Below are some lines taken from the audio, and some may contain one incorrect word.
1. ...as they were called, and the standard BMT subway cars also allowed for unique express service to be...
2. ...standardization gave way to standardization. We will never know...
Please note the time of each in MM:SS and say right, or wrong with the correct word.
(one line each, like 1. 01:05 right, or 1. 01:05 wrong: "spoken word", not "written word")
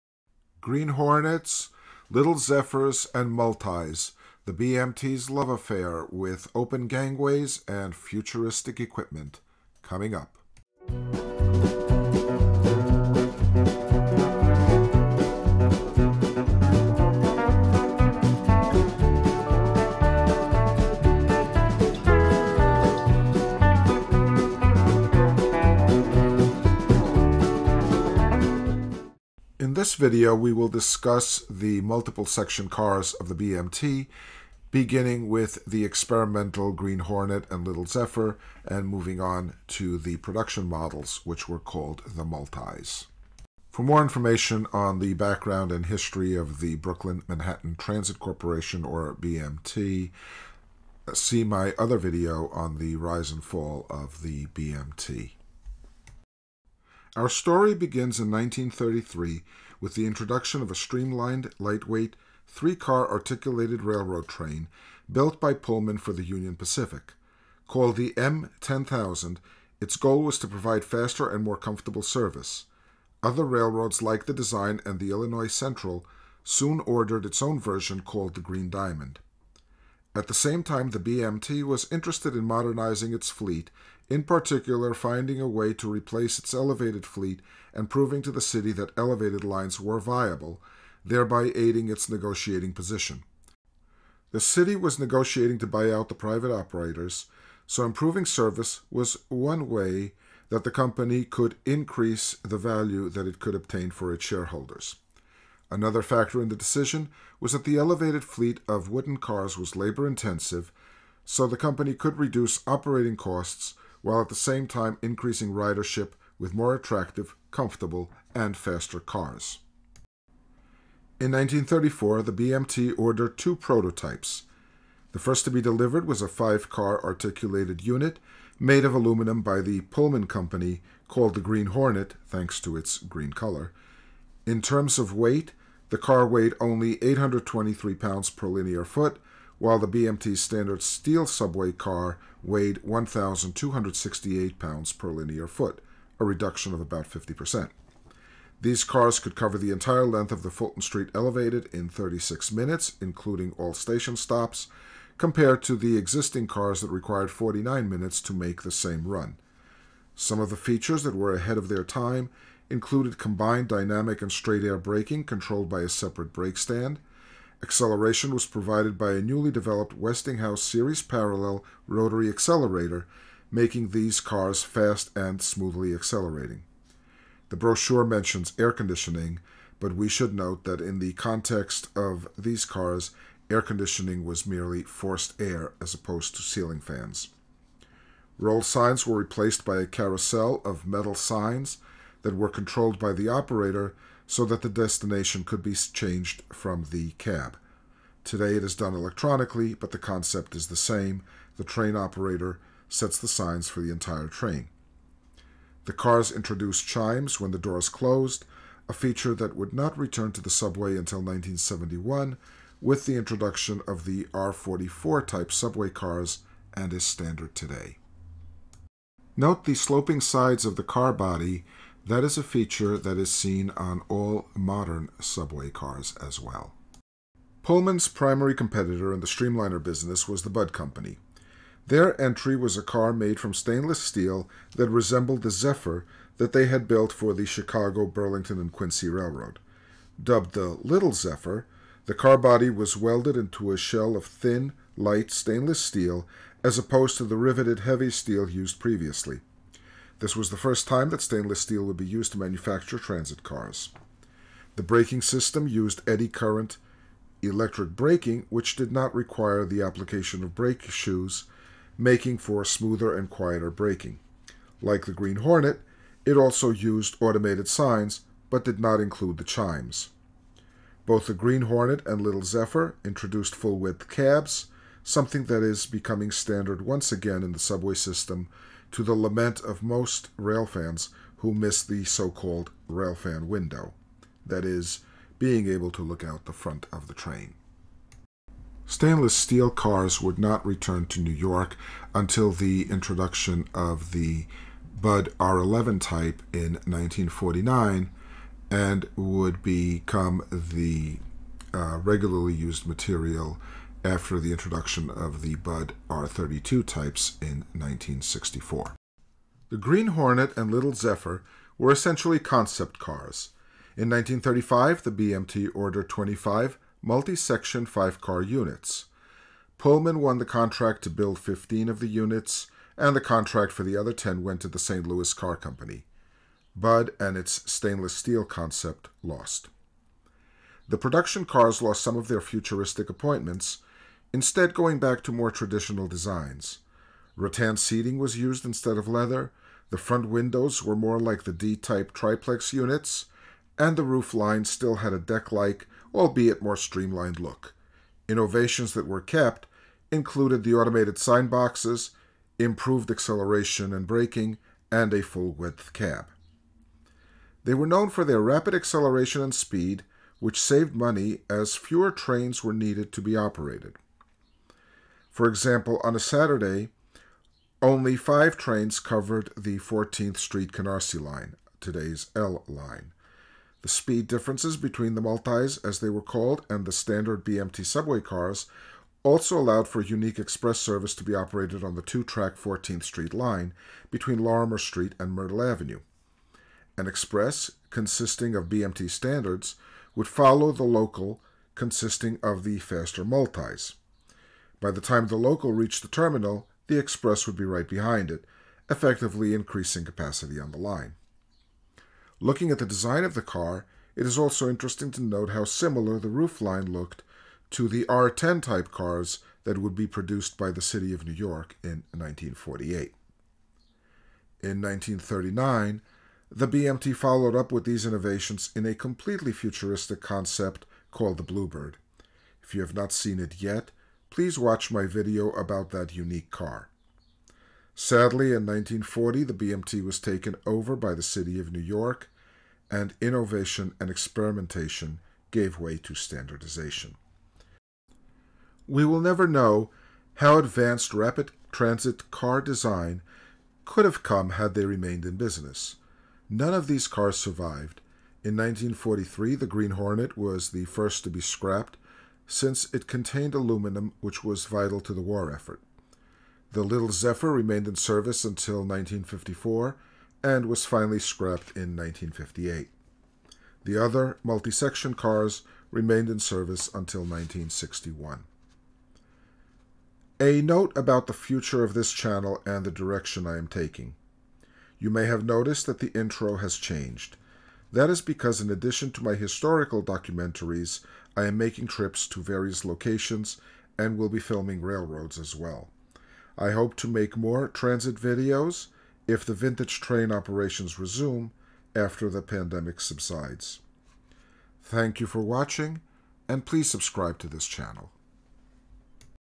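1. 06:15 right
2. 07:14 wrong: "experimentation", not "standardization".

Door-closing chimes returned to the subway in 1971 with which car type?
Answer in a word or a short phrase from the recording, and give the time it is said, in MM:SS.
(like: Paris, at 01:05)
R44, at 03:34.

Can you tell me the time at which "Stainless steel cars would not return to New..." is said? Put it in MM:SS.
04:48.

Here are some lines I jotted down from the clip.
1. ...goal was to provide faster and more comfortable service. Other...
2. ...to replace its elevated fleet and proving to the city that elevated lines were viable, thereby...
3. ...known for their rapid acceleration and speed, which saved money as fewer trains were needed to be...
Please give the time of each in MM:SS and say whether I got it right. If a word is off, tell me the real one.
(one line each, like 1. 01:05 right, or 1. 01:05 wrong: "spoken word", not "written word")
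1. 01:09 right
2. 01:25 right
3. 05:57 right.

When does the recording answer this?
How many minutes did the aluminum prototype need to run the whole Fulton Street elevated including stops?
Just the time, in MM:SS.
02:31.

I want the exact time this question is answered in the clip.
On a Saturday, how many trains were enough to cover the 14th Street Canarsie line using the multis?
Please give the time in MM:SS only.
06:08.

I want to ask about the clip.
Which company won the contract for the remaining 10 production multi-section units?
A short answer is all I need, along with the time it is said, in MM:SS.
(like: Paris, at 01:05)
St. Louis Car Company, at 05:24.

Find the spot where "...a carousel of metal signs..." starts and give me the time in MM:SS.
03:09.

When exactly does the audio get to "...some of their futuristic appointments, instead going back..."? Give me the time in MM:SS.
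05:32.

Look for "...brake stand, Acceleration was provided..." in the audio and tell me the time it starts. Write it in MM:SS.
02:46.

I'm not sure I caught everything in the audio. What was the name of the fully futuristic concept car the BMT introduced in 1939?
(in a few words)
Bluebird.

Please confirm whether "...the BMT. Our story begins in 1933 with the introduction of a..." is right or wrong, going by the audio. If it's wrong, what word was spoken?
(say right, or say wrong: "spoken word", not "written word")
right.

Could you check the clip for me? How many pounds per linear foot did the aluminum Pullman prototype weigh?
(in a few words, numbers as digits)
823.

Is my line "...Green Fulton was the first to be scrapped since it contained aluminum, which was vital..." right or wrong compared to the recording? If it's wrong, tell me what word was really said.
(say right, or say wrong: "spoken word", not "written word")
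wrong: "Hornet", not "Fulton".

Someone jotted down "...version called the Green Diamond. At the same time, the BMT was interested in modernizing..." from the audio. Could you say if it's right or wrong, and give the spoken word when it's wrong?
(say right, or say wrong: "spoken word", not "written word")
right.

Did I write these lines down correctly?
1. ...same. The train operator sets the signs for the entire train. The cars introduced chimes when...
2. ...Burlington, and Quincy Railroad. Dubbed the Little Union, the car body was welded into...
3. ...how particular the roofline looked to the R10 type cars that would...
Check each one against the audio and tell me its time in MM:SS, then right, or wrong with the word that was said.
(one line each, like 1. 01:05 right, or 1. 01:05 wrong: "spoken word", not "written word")
1. 03:20 right
2. 03:58 wrong: "Zephyr", not "Union"
3. 06:45 wrong: "similar", not "particular".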